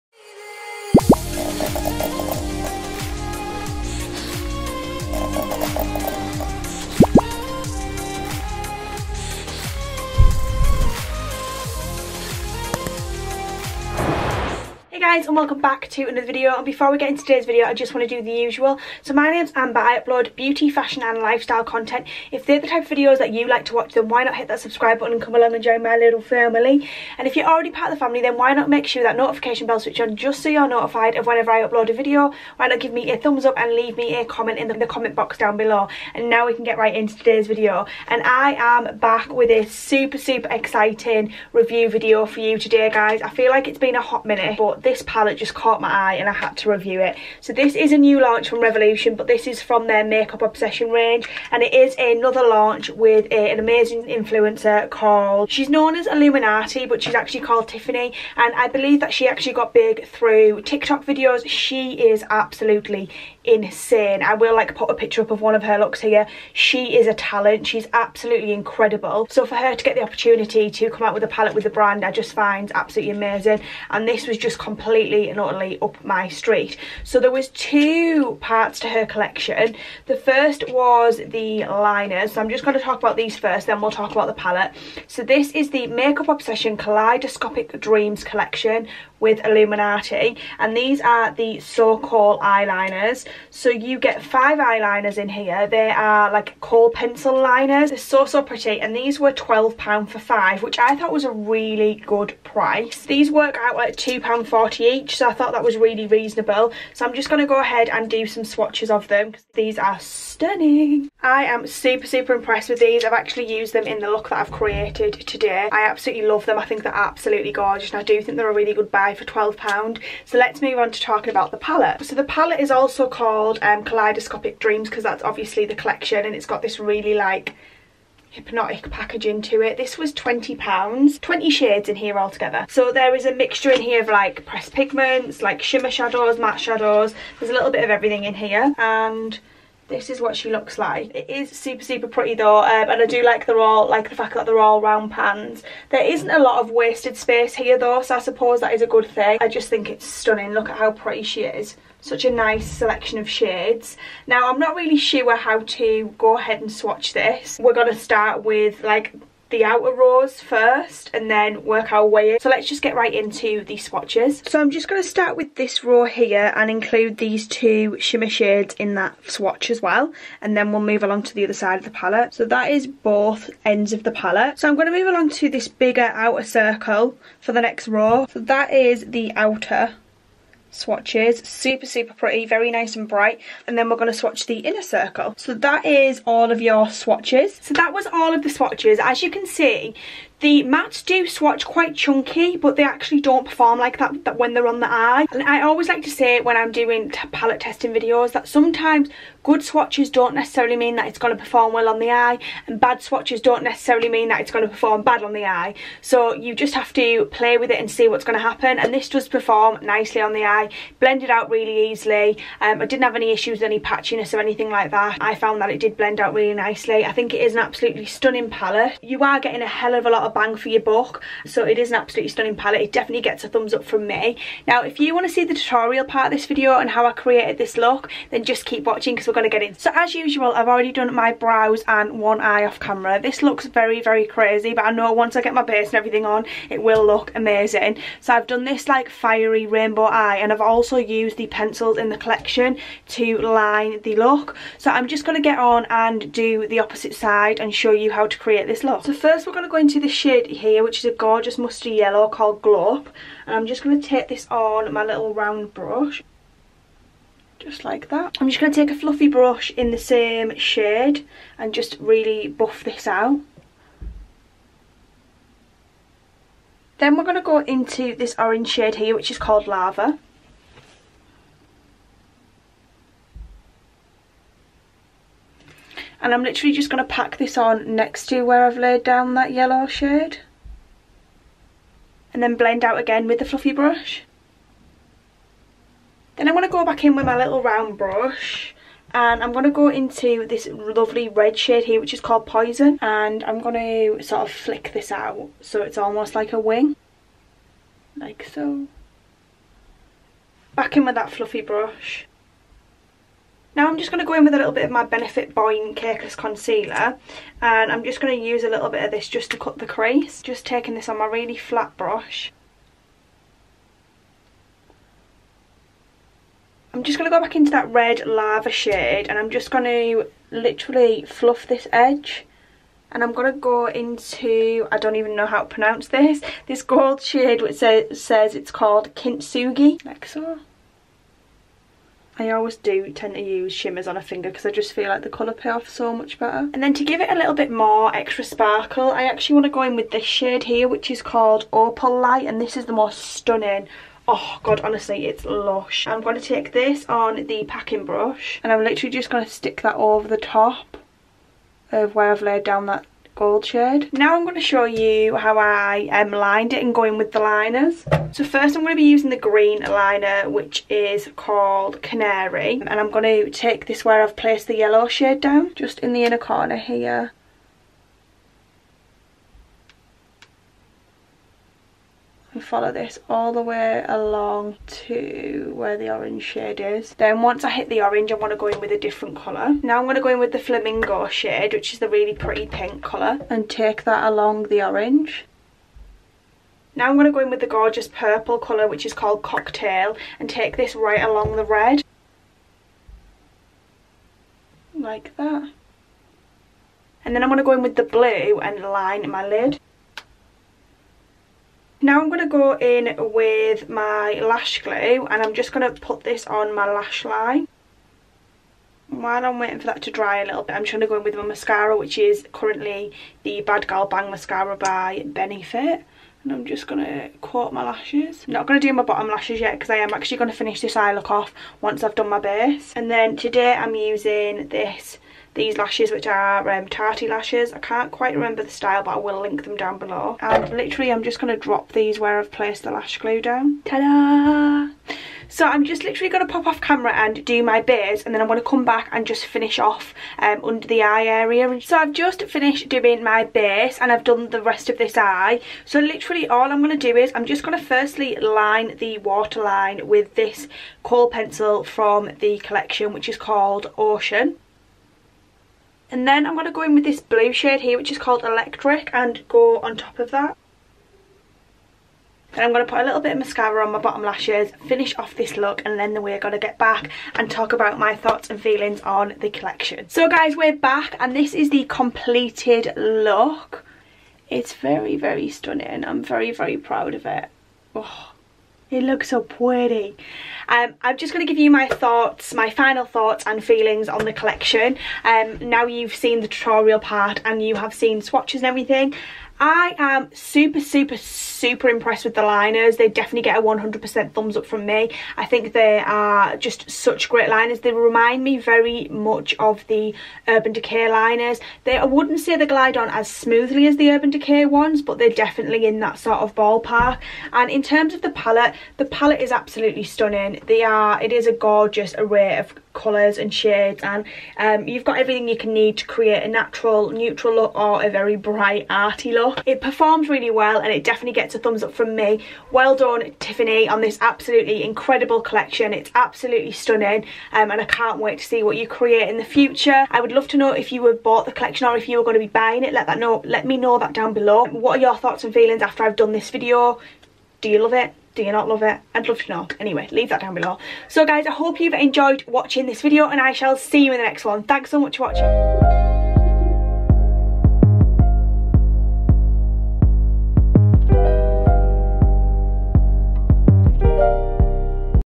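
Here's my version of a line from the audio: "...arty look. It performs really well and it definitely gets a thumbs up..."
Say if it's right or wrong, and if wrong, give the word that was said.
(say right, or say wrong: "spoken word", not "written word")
right.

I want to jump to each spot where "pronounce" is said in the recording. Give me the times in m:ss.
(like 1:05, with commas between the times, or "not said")
5:25.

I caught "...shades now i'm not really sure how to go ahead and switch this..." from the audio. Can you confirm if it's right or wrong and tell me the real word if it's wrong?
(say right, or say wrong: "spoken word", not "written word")
wrong: "swatch", not "switch".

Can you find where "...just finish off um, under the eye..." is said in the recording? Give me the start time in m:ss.
7:19.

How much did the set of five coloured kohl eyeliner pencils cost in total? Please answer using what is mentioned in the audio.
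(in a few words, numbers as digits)
£12.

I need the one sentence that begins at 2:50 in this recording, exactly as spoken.
And then we'll move along to the other side of the palette.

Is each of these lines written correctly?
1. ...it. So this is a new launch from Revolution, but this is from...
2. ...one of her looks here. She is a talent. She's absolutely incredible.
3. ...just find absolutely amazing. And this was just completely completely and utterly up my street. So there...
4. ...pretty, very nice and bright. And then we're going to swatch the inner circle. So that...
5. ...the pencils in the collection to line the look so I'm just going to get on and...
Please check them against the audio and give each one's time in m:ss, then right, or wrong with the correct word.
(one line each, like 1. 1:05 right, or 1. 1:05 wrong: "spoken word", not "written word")
1. 0:47 right
2. 1:05 right
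3. 1:12 right
4. 3:02 right
5. 4:01 right.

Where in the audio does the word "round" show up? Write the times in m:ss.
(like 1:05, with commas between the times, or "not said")
2:24, 4:15, 4:47.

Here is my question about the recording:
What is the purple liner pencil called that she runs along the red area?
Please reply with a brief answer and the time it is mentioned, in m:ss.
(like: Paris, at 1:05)
Cocktail, at 6:29.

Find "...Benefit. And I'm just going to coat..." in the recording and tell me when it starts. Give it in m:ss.
6:55.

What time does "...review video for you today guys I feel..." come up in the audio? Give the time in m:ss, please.
0:41.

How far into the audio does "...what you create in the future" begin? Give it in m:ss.
8:48.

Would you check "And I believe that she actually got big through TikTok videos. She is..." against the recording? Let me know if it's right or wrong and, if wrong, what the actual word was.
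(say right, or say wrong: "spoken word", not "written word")
right.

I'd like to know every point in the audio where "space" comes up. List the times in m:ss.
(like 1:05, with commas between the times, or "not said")
2:27.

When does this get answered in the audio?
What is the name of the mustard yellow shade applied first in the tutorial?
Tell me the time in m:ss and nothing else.
4:12.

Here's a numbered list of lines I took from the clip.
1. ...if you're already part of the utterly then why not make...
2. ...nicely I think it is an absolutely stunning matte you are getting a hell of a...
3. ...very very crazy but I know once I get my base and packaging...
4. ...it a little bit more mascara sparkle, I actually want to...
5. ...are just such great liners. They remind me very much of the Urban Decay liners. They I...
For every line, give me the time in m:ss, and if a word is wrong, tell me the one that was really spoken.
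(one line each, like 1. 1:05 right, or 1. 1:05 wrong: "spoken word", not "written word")
1. 0:27 wrong: "family", not "utterly"
2. 3:36 wrong: "palette", not "matte"
3. 3:53 wrong: "everything", not "packaging"
4. 5:37 wrong: "extra", not "mascara"
5. 8:15 right.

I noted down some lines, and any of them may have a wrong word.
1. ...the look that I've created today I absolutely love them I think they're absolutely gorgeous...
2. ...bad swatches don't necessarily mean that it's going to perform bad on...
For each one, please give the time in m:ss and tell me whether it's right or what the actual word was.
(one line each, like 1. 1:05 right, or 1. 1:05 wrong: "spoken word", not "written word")
1. 1:53 right
2. 3:22 right.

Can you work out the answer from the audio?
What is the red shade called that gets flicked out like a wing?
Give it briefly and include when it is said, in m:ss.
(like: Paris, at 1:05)
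Poison, at 4:52.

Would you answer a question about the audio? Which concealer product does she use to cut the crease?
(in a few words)
Benefit Boing Cakeless Concealer.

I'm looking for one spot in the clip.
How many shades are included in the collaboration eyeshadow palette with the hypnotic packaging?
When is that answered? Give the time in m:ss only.
2:11.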